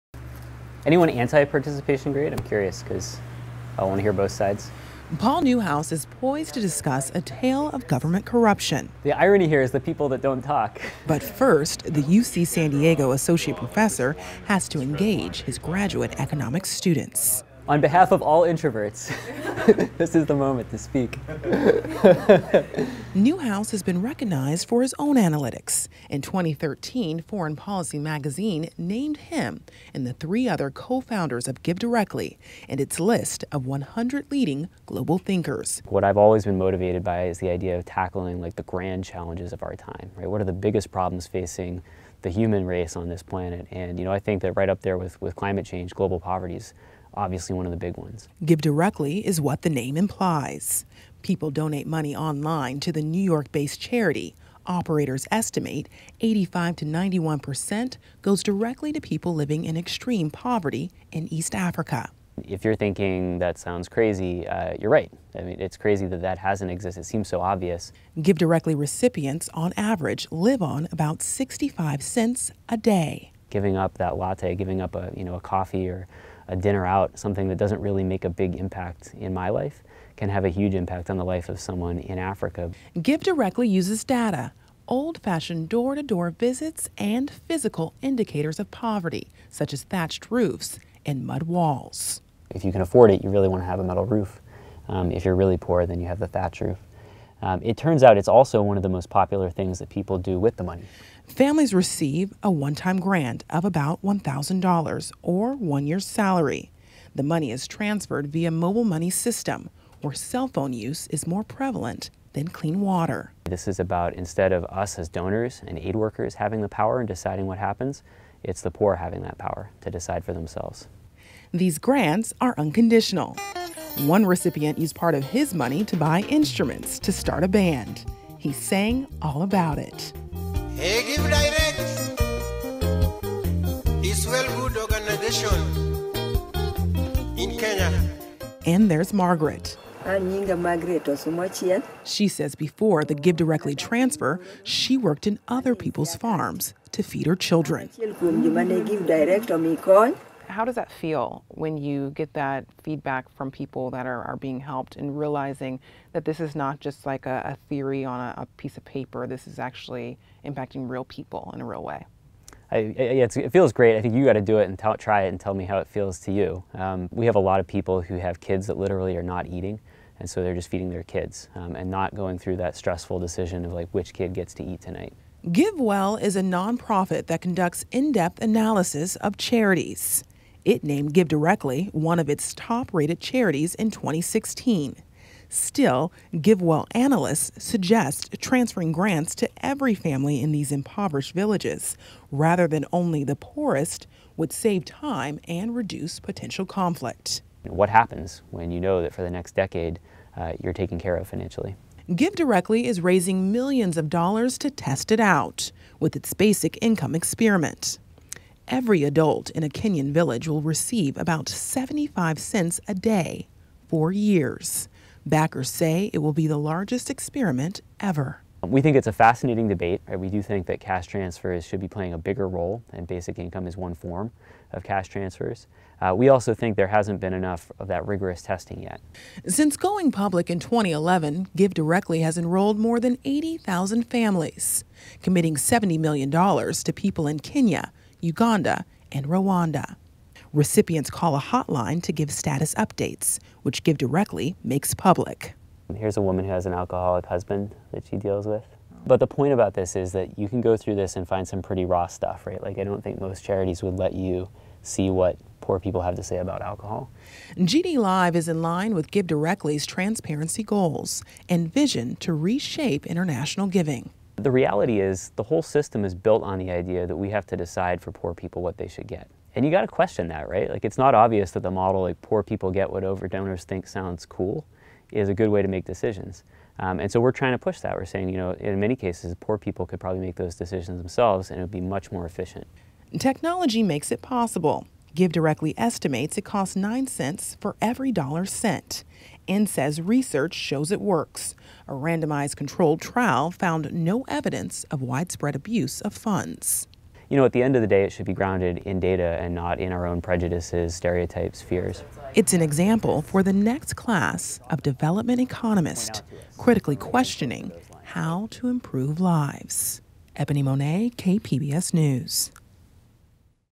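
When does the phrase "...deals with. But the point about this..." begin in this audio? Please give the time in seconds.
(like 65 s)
248 s.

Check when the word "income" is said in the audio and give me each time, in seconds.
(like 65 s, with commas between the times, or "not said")
206 s, 223 s.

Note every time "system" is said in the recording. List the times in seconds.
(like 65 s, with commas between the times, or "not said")
109 s, 265 s.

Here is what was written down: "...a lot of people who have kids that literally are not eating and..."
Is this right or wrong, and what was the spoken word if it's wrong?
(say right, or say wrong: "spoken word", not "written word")
right.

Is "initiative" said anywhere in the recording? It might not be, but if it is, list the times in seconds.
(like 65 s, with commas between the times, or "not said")
not said.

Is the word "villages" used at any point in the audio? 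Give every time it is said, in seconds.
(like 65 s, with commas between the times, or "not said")
191 s, 210 s.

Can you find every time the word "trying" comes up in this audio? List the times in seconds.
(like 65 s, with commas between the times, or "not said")
277 s.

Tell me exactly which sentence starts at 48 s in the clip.
Give Directly is what the name implies.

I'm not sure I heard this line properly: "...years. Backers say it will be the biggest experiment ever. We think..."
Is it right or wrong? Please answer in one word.
wrong.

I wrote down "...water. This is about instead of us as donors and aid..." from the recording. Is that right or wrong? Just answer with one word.
right.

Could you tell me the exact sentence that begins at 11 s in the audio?
But first, the UC San Diego associate professor has to engage his graduate economics students.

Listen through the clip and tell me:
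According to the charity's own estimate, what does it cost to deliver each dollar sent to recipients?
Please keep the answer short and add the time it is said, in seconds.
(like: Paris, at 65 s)
9 cents, at 286 s.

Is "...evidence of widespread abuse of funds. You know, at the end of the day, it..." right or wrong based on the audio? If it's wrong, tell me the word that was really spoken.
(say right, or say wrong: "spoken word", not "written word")
right.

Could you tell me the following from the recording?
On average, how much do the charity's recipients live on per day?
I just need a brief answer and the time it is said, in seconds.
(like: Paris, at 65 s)
65 cents, at 71 s.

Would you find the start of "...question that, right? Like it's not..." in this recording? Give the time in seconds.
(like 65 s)
269 s.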